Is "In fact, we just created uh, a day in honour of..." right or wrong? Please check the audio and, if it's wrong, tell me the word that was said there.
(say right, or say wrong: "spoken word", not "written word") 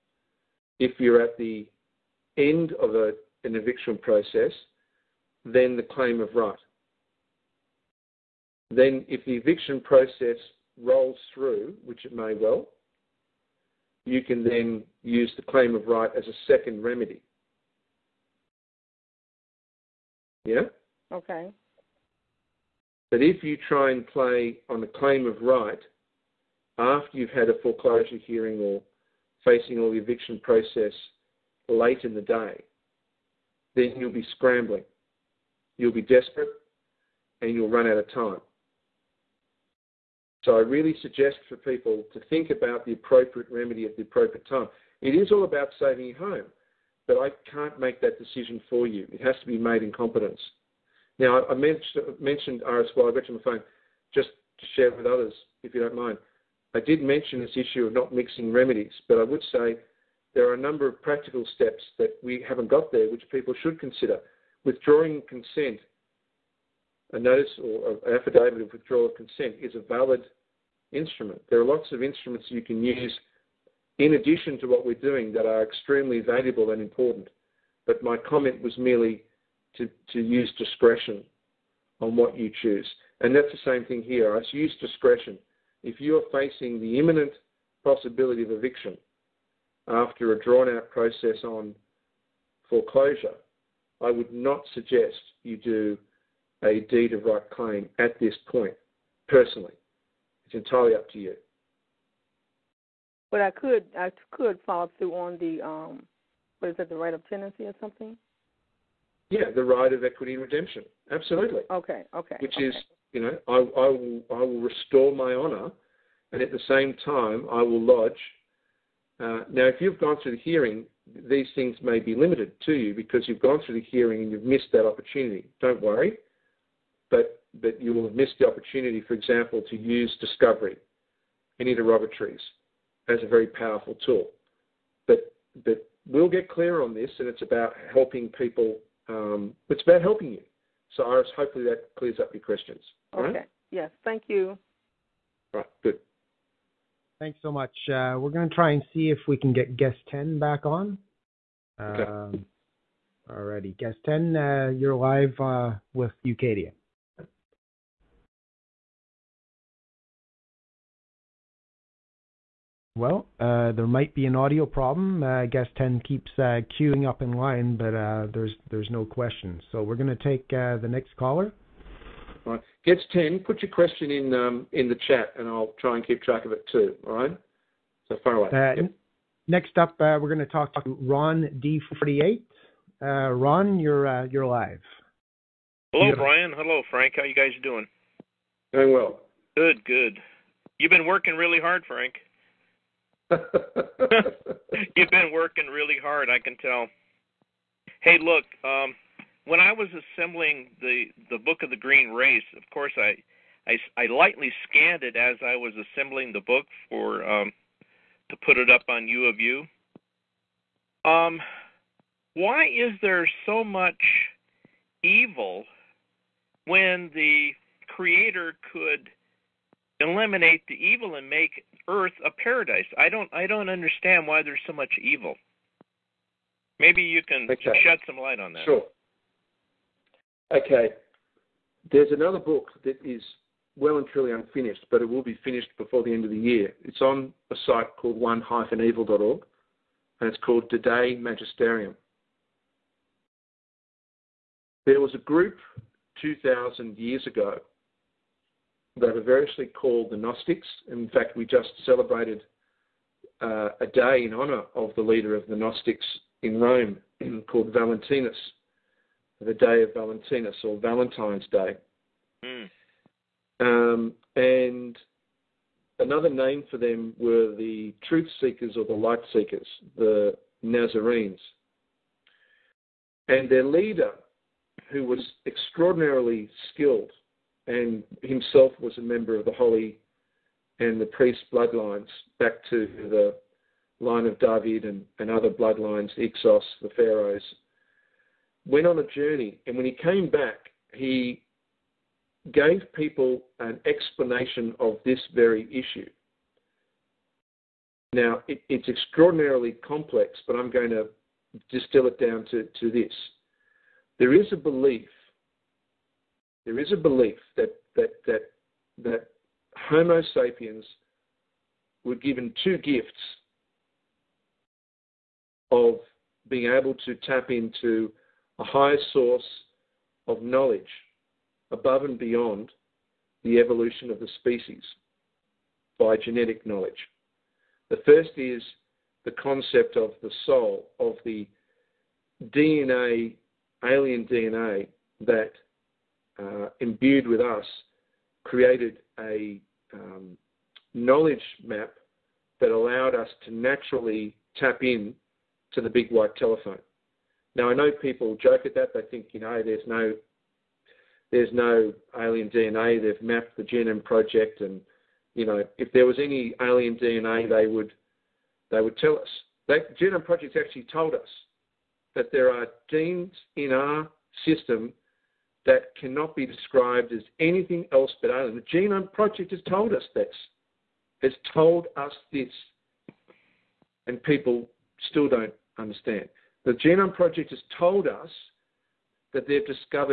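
wrong: "celebrated", not "created".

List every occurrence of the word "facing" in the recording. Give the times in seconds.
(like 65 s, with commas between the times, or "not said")
29 s, 86 s.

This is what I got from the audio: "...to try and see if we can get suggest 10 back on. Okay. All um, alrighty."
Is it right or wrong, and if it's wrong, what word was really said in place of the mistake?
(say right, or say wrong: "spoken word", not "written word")
wrong: "guest", not "suggest".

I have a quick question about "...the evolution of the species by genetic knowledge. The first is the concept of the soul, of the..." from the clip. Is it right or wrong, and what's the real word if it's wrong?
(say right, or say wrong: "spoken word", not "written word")
right.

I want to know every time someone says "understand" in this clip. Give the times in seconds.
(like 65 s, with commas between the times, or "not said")
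223 s, 375 s.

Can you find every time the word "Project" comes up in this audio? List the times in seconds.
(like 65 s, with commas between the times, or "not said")
354 s, 360 s, 369 s, 377 s.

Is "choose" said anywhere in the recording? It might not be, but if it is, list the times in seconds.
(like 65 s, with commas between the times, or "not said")
82 s.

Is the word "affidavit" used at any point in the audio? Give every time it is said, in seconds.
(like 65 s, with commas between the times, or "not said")
68 s.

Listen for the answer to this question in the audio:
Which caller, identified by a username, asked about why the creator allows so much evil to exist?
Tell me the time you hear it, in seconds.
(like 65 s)
181 s.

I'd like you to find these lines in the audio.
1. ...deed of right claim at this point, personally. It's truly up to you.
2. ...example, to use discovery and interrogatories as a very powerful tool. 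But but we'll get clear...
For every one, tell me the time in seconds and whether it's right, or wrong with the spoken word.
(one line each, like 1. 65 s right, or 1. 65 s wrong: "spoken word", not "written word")
1. 96 s wrong: "entirely", not "truly"
2. 129 s right.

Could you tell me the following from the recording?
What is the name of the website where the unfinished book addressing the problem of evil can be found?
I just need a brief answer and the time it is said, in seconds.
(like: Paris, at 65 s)
one-evil.org, at 238 s.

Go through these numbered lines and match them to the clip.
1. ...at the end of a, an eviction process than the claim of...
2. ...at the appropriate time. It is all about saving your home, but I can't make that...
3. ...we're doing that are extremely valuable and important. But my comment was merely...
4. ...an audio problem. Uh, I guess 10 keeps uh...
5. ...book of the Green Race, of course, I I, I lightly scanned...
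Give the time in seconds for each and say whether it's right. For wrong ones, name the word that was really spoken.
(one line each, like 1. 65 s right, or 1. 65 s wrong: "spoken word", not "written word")
1. 1 s right
2. 43 s right
3. 74 s right
4. 164 s right
5. 201 s right.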